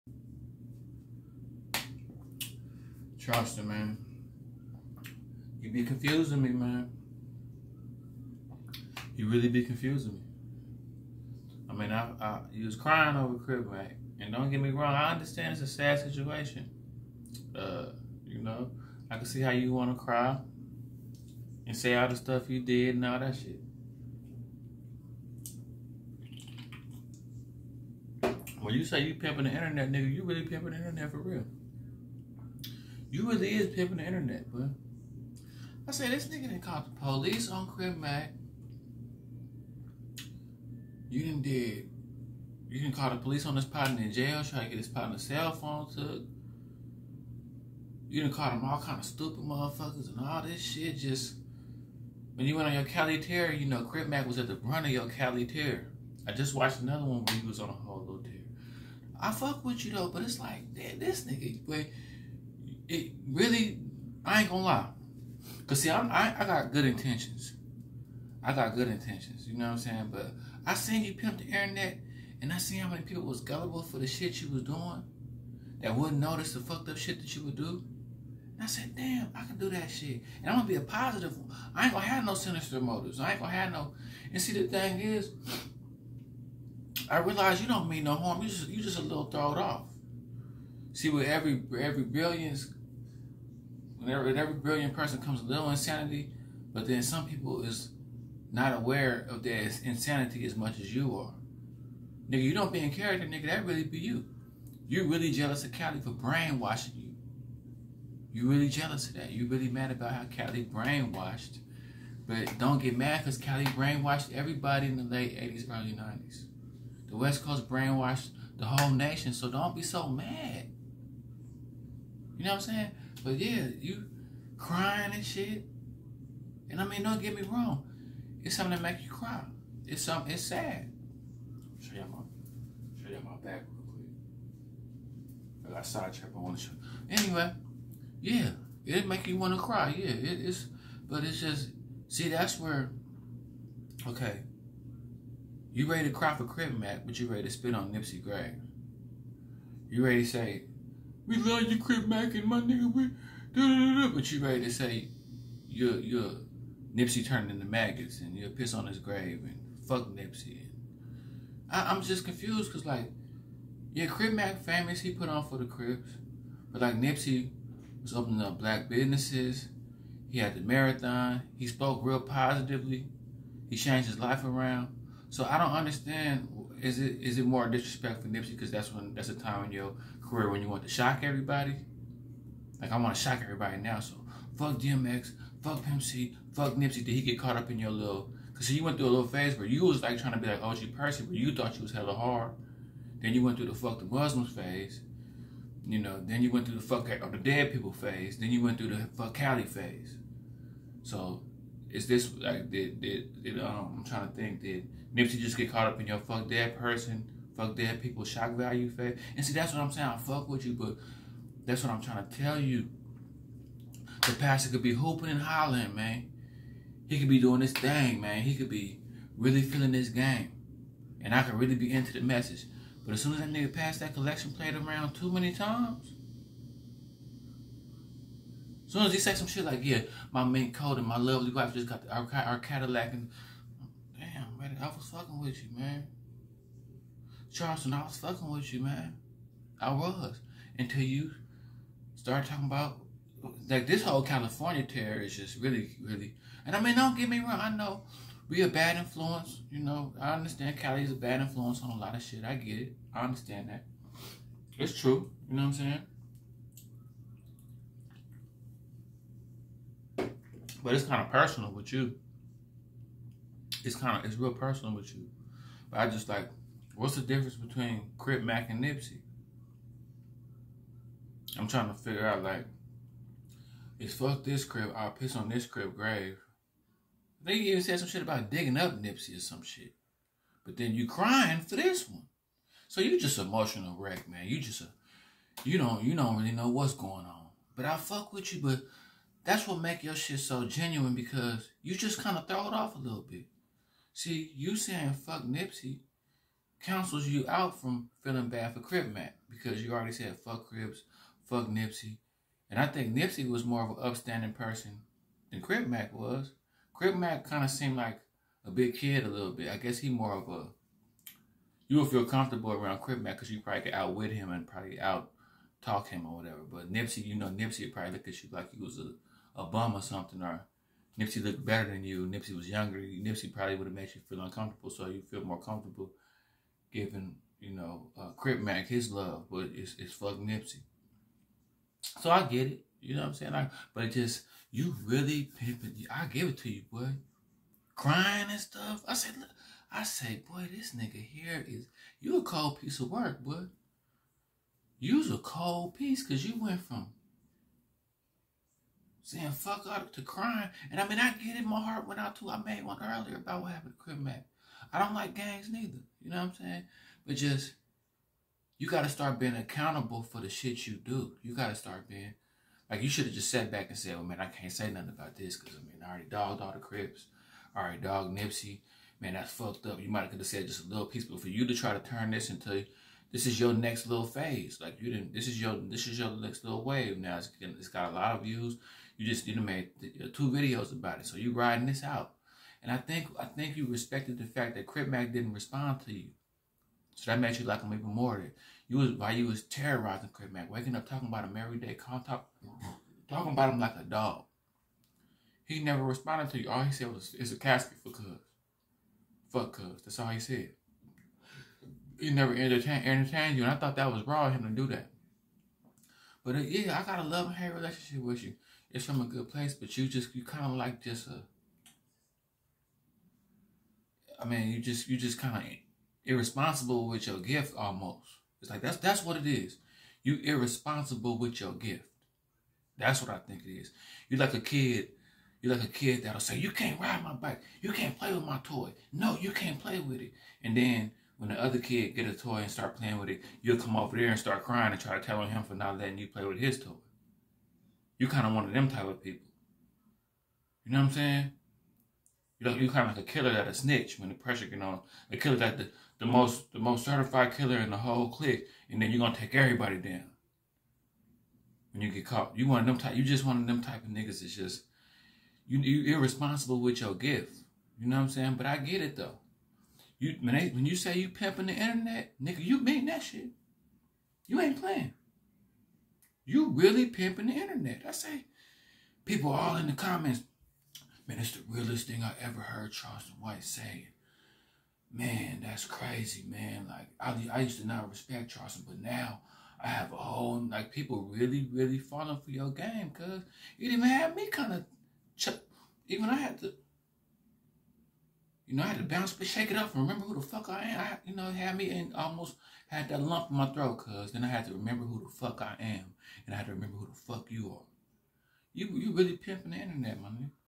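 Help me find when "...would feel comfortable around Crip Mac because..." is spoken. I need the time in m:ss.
5:11.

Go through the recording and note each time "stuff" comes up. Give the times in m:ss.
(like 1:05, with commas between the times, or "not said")
0:22, 5:38.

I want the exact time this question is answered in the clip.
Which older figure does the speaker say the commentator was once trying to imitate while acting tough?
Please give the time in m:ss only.
3:10.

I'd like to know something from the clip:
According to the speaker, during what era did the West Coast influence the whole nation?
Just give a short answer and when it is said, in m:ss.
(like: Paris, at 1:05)
late 80s, early 90s, at 1:55.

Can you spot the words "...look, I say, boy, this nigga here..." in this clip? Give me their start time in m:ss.
5:39.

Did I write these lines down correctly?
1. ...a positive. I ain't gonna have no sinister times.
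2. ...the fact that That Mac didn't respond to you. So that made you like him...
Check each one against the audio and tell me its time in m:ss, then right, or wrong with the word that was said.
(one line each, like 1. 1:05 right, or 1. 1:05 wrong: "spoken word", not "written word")
1. 1:20 wrong: "motives", not "times"
2. 6:24 wrong: "Crip", not "That".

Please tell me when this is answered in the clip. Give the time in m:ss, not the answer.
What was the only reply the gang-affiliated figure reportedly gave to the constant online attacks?
6:37.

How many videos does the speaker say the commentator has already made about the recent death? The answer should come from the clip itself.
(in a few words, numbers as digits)
2.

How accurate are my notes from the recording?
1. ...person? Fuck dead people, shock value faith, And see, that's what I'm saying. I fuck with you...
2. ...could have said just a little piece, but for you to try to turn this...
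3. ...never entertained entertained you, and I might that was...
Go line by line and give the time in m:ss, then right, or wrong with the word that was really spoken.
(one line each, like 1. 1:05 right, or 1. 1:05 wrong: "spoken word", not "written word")
1. 3:26 right
2. 6:10 right
3. 6:42 wrong: "thought", not "might".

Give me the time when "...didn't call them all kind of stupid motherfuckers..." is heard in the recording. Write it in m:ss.
0:48.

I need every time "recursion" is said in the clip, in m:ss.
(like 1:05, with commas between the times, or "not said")
not said.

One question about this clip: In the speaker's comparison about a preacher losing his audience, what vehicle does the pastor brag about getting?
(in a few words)
Cadillac.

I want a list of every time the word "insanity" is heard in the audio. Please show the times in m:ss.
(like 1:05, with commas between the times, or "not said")
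1:35, 1:39.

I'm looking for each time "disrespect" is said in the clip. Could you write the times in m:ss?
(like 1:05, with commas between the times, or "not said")
2:57.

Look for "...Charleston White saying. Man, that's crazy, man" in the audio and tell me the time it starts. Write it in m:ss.
7:52.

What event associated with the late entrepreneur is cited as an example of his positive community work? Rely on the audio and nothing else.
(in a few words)
the marathon.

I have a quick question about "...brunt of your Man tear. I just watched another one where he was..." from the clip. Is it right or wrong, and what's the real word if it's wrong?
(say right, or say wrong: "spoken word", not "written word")
wrong: "Cali", not "Man".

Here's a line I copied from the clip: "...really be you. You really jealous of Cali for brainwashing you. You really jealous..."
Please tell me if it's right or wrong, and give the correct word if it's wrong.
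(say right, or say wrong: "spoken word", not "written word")
right.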